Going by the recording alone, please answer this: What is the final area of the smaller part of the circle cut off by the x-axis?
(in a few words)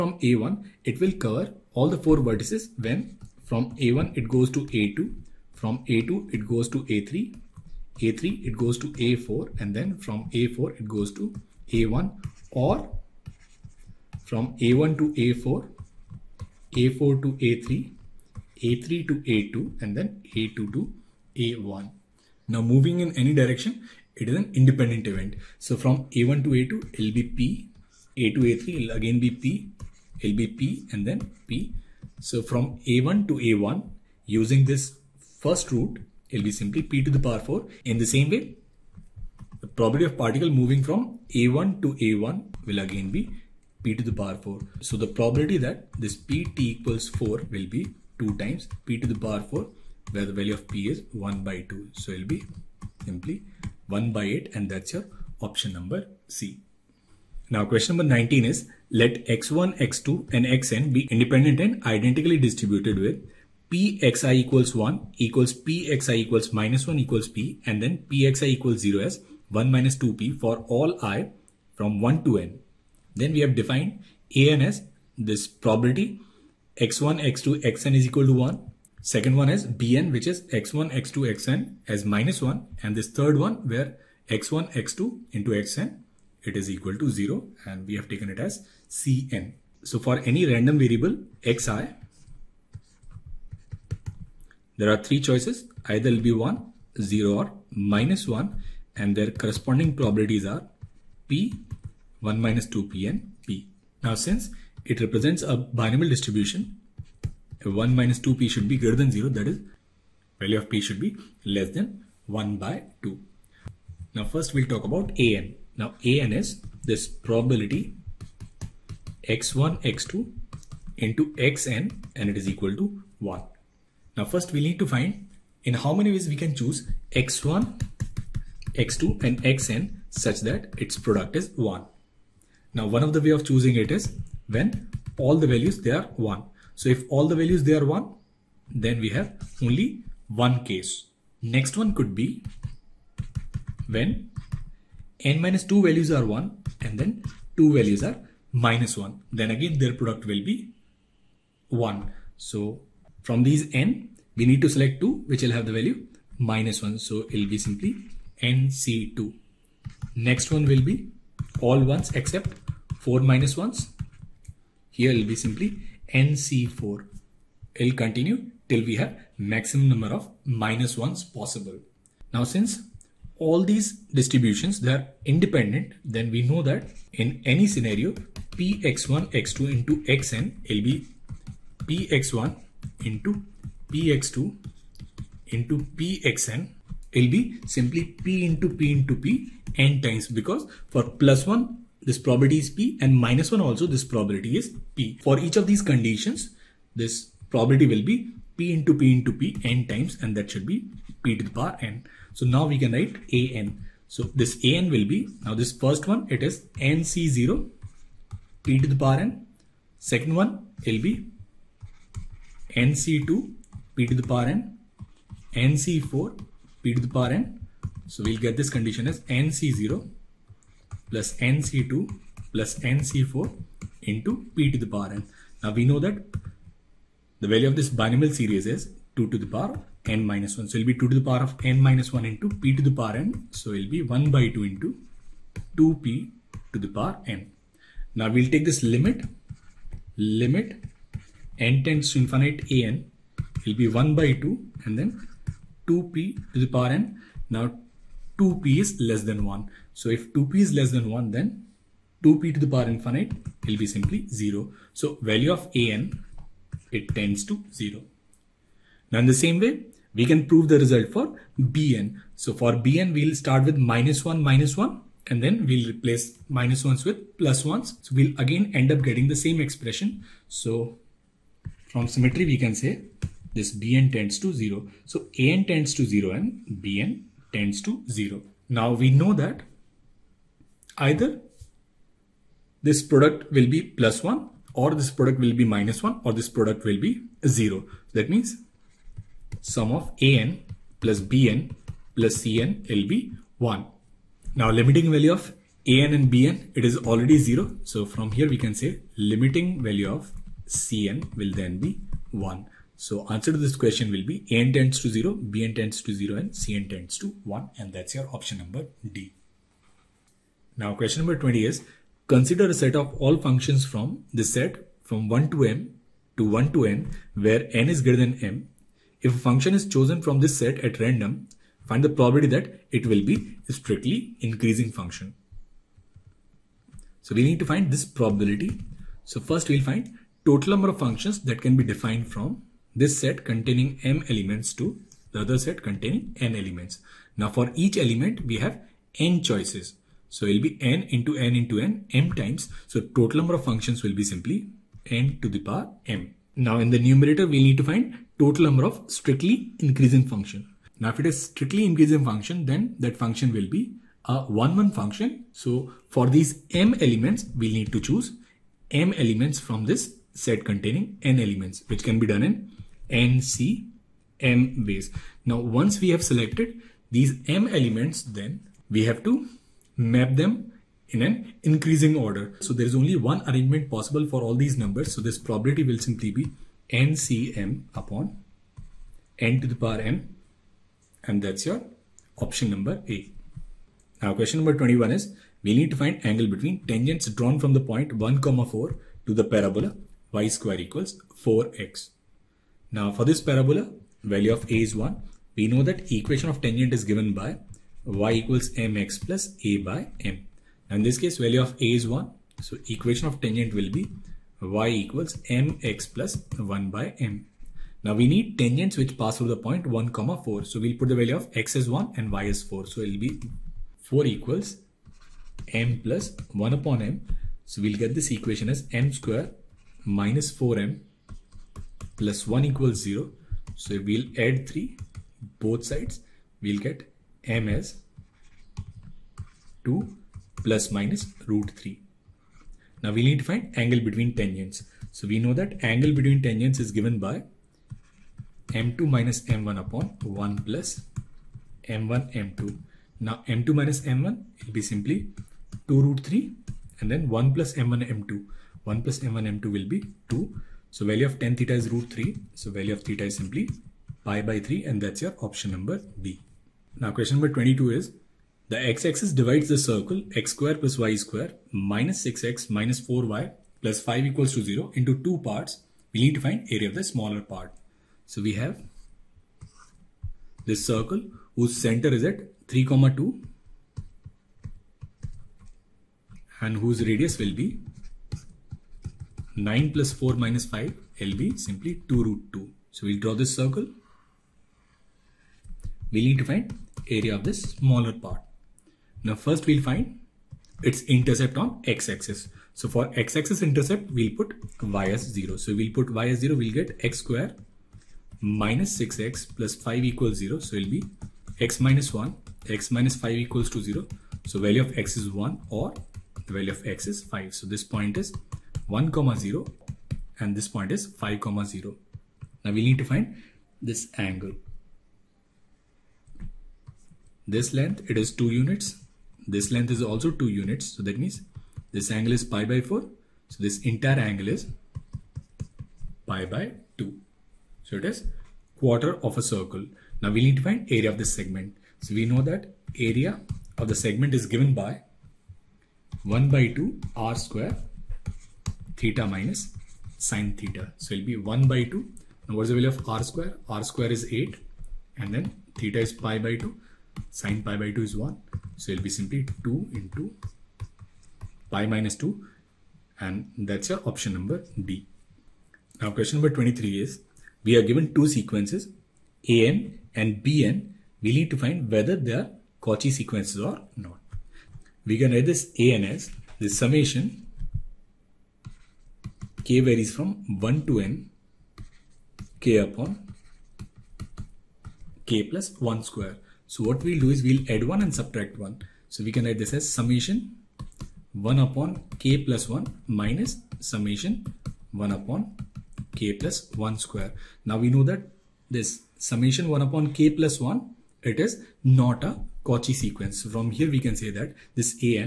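2(π − 2).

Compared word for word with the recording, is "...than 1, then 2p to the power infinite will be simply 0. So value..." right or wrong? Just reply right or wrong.
right.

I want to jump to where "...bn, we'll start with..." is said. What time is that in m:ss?
4:22.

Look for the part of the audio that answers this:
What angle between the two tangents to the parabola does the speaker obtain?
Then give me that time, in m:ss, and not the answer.
7:34.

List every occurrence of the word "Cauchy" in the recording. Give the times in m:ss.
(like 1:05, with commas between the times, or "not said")
9:22, 9:52.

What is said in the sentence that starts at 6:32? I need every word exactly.
Now for this parabola value of a is 1.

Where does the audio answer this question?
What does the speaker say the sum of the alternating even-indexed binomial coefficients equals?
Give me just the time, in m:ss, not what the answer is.
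3:49.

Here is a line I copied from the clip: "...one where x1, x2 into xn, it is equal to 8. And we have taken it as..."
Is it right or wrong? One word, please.
wrong.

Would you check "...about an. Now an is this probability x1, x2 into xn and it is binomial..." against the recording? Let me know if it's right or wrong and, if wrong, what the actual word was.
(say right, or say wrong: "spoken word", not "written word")
wrong: "equal", not "binomial".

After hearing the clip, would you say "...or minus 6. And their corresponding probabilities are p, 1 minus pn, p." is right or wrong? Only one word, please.
wrong.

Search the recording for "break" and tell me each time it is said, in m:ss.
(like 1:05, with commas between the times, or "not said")
not said.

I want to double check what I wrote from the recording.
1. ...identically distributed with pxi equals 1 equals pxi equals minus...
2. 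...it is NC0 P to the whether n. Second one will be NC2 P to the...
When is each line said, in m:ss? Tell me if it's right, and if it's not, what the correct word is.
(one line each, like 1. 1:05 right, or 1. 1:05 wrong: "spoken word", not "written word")
1. 1:01 right
2. 3:26 wrong: "power", not "whether".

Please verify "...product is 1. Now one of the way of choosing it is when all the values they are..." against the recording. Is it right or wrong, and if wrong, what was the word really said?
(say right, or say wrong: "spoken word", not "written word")
right.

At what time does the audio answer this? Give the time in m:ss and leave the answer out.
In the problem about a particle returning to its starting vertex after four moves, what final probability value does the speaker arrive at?
0:53.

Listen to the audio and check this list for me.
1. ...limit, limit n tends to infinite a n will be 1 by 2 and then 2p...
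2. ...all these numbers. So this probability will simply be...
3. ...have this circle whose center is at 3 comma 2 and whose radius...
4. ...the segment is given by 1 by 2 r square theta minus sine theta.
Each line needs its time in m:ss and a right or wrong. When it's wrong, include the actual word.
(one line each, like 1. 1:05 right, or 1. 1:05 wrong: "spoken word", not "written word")
1. 3:58 right
2. 6:14 right
3. 7:48 right
4. 8:53 right.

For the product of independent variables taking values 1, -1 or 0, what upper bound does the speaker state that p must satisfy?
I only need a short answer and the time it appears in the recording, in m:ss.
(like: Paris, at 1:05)
less than 1/2, at 1:51.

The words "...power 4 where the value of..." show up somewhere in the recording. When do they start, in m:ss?
0:49.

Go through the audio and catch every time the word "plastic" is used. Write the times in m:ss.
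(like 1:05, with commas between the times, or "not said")
not said.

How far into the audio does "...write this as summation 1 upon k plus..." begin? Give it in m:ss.
9:39.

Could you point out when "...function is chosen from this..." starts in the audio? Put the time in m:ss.
5:19.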